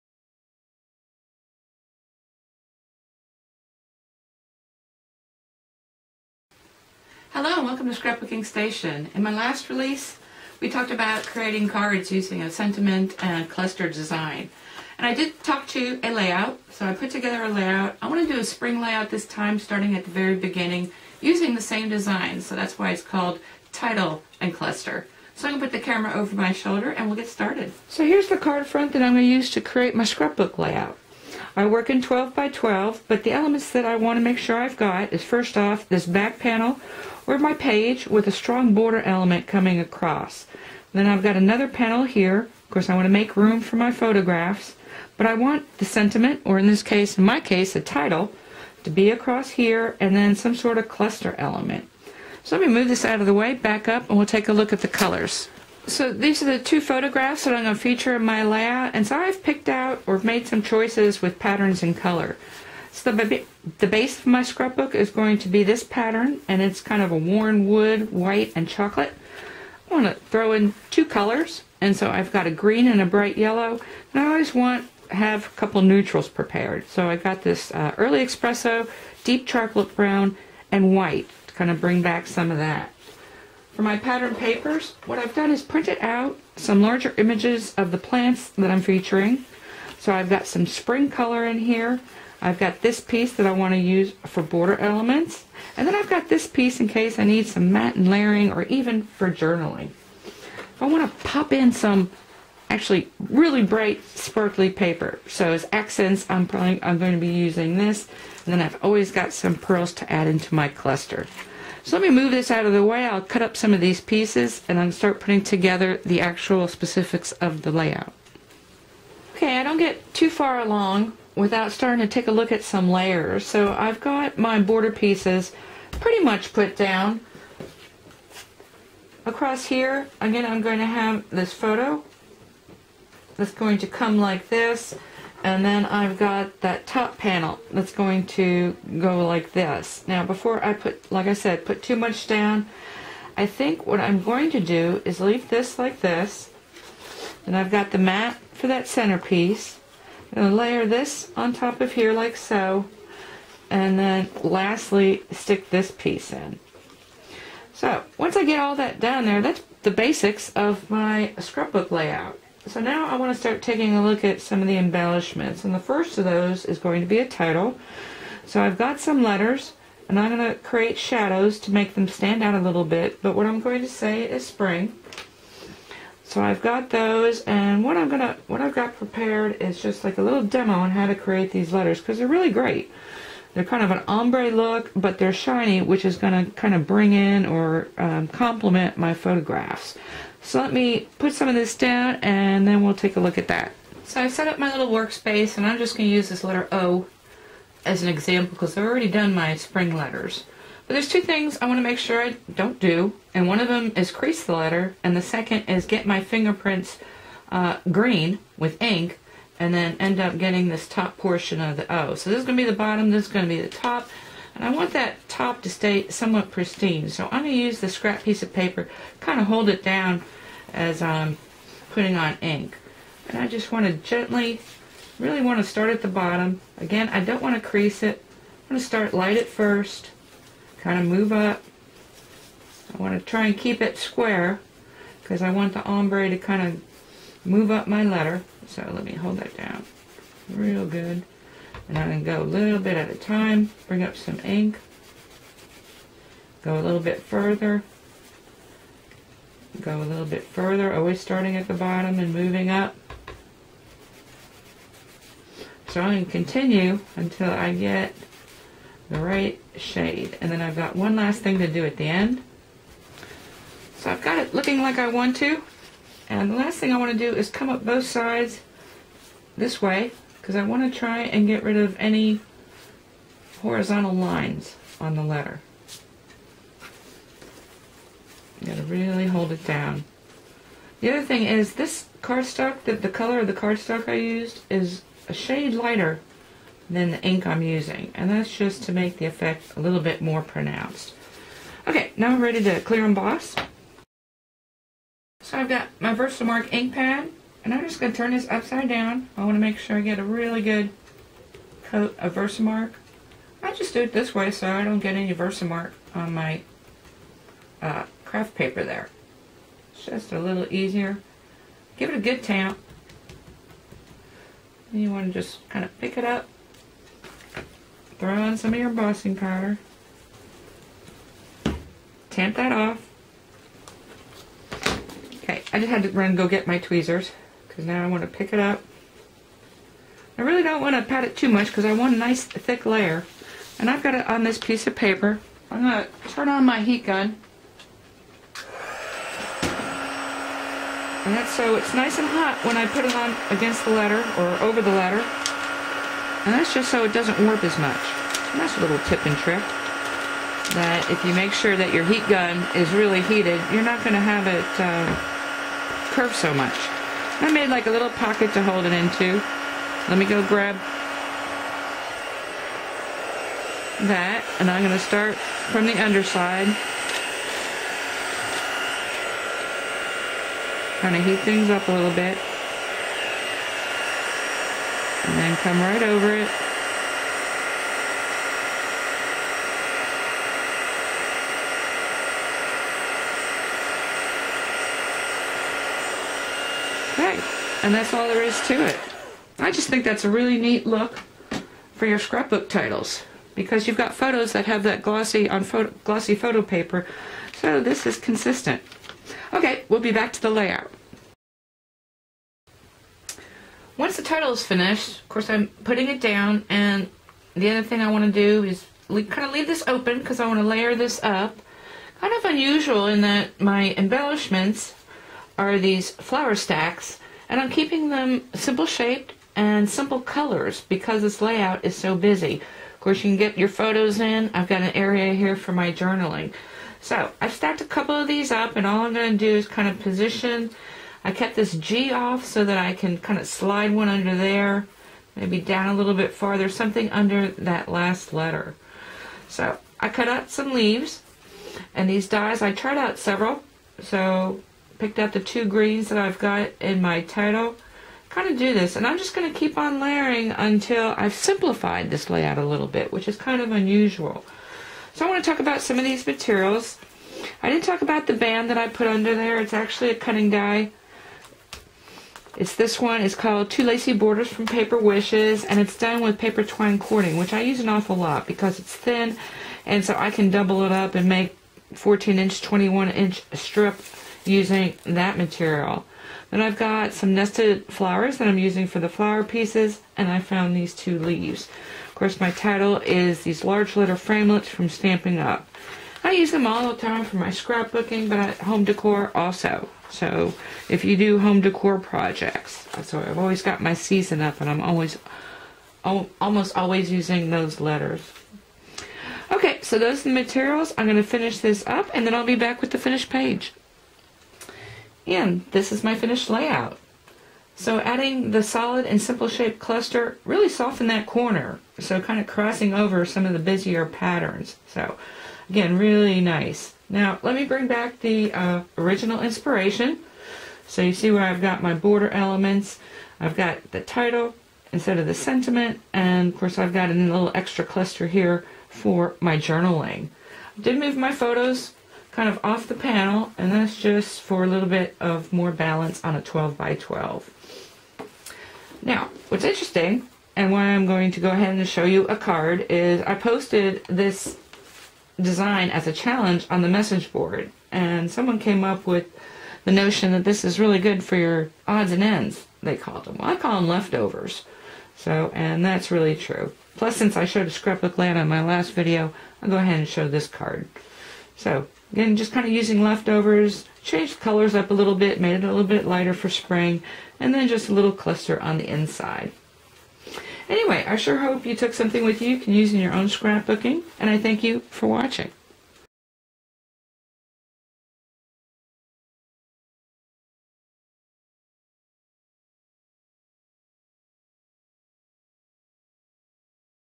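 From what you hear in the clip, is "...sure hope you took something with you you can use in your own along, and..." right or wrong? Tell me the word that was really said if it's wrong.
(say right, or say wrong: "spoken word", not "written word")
wrong: "scrapbooking", not "along".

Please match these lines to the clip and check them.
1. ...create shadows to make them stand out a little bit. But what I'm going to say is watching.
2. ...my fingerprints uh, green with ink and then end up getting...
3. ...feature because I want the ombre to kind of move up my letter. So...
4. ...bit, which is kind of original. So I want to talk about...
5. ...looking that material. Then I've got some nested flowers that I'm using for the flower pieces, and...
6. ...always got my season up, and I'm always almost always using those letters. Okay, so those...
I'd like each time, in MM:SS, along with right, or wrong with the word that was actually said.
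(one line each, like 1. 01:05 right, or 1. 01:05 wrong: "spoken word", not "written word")
1. 02:50 wrong: "spring", not "watching"
2. 03:26 right
3. 03:53 wrong: "square", not "feature"
4. 07:32 wrong: "unusual", not "original"
5. 07:54 wrong: "using", not "looking"
6. 08:13 right.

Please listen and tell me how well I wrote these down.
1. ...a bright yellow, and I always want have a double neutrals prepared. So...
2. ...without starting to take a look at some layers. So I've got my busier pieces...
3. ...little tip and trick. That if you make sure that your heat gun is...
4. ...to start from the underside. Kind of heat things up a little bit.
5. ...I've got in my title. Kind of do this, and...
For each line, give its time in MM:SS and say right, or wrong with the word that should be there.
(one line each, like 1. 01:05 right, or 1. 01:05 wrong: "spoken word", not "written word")
1. 01:13 wrong: "couple", not "double"
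2. 02:01 wrong: "border", not "busier"
3. 05:48 right
4. 06:04 right
5. 07:26 right.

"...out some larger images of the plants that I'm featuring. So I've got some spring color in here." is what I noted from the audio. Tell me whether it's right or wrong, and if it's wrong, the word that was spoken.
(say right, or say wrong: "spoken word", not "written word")
right.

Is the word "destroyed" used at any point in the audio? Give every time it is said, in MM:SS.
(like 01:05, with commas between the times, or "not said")
not said.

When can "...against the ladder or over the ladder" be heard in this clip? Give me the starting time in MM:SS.
05:43.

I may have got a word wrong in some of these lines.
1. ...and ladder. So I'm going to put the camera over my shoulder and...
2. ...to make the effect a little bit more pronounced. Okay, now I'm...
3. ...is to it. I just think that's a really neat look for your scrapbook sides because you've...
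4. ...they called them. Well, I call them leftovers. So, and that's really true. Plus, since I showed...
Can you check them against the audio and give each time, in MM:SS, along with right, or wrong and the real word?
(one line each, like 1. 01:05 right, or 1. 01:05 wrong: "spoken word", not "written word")
1. 00:24 wrong: "cluster", not "ladder"
2. 04:48 right
3. 06:28 wrong: "titles", not "sides"
4. 09:12 right.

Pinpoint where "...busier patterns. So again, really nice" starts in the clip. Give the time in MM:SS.
08:33.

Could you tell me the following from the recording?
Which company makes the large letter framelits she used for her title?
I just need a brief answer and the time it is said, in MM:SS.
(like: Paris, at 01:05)
Stampin' Up, at 08:04.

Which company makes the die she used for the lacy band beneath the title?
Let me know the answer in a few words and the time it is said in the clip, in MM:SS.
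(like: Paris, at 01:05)
Paper Wishes, at 07:44.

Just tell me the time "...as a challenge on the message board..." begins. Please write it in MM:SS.
09:05.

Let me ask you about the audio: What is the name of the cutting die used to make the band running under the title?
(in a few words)
Two Lacy Borders.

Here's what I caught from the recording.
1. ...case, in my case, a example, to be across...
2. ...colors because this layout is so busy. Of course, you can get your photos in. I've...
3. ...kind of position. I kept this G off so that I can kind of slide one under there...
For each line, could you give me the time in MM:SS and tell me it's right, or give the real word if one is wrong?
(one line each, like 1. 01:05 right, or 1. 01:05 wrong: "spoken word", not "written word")
1. 00:46 wrong: "title", not "example"
2. 07:00 right
3. 07:09 right.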